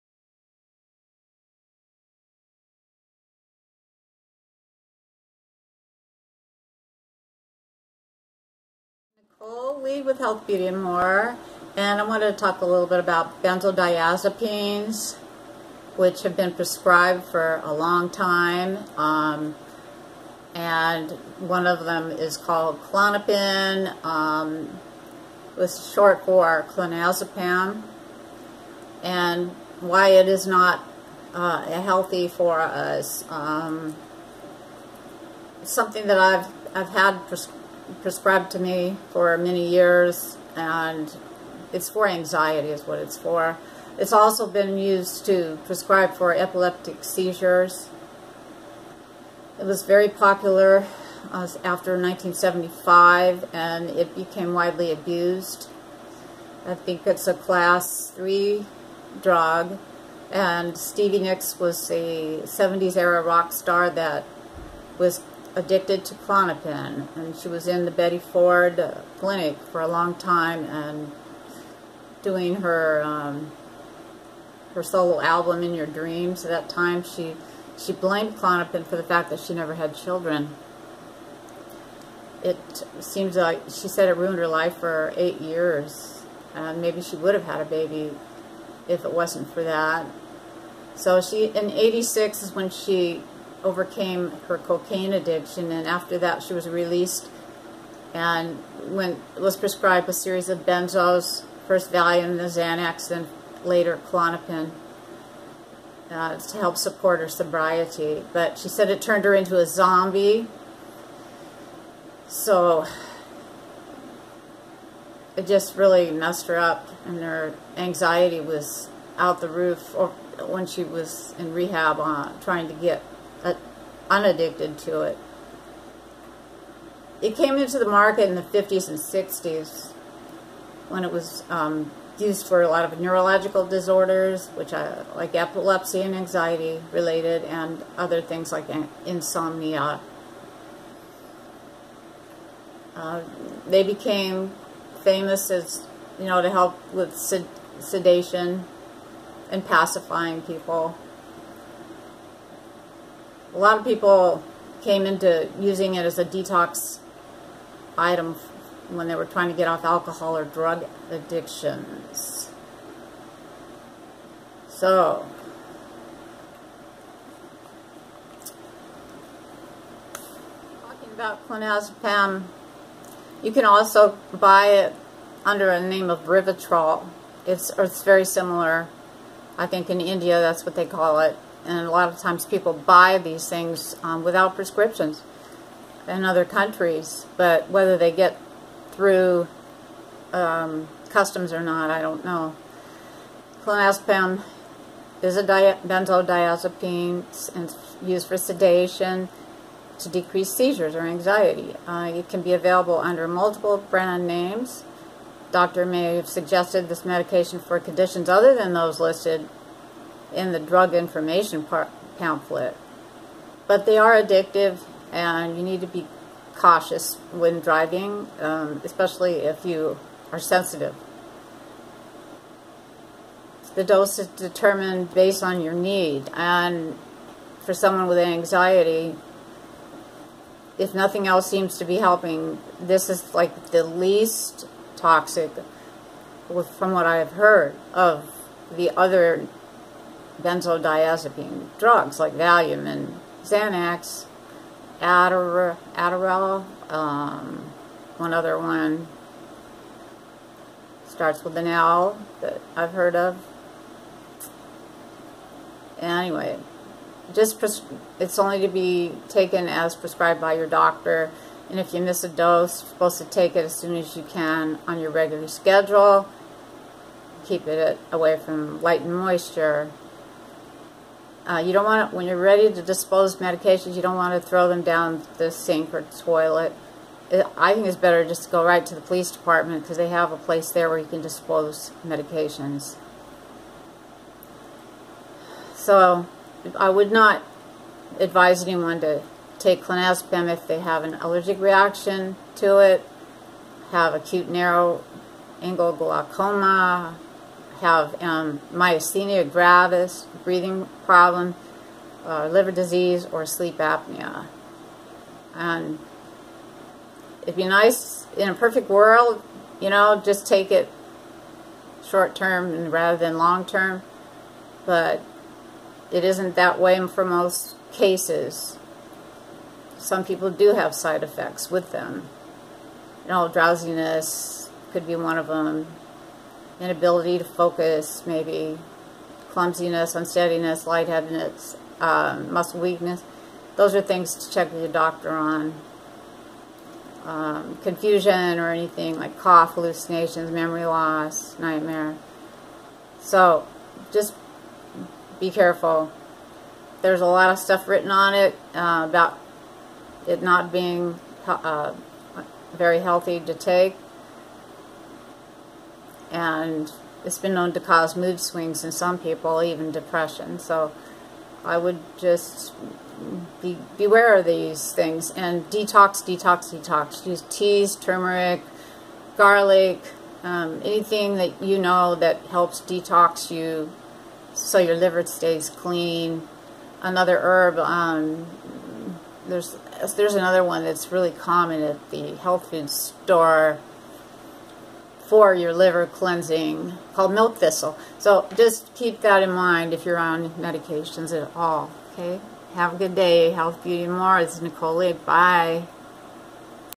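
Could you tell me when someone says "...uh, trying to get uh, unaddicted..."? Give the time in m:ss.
2:01.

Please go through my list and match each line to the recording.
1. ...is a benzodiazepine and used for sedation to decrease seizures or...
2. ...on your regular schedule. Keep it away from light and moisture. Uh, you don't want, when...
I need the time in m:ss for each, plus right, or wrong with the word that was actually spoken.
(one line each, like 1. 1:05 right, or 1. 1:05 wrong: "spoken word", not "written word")
1. 3:15 right
2. 4:24 right.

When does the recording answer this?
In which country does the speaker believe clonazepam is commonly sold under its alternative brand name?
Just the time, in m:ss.
3:00.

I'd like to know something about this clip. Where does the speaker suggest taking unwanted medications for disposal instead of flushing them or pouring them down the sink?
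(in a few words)
The police department.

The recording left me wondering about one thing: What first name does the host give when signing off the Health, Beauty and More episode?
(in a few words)
Nicole.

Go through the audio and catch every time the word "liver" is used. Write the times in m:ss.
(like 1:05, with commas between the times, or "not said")
5:02, 6:14, 6:25.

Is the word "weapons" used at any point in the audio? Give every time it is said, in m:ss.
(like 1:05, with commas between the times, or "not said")
not said.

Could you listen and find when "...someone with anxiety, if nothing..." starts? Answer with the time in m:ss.
3:47.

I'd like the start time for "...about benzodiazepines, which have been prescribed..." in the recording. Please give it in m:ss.
0:12.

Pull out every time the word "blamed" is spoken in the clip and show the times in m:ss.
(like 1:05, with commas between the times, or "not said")
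1:17.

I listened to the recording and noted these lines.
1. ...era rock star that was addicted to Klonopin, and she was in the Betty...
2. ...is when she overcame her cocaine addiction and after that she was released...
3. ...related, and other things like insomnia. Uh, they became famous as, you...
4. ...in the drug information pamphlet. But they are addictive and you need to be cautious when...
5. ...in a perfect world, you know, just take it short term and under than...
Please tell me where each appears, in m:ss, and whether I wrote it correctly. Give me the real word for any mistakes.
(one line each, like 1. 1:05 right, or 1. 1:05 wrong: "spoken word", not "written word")
1. 1:02 right
2. 1:32 right
3. 2:16 right
4. 3:30 right
5. 5:08 wrong: "rather", not "under".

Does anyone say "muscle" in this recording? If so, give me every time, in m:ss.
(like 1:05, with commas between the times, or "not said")
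5:32.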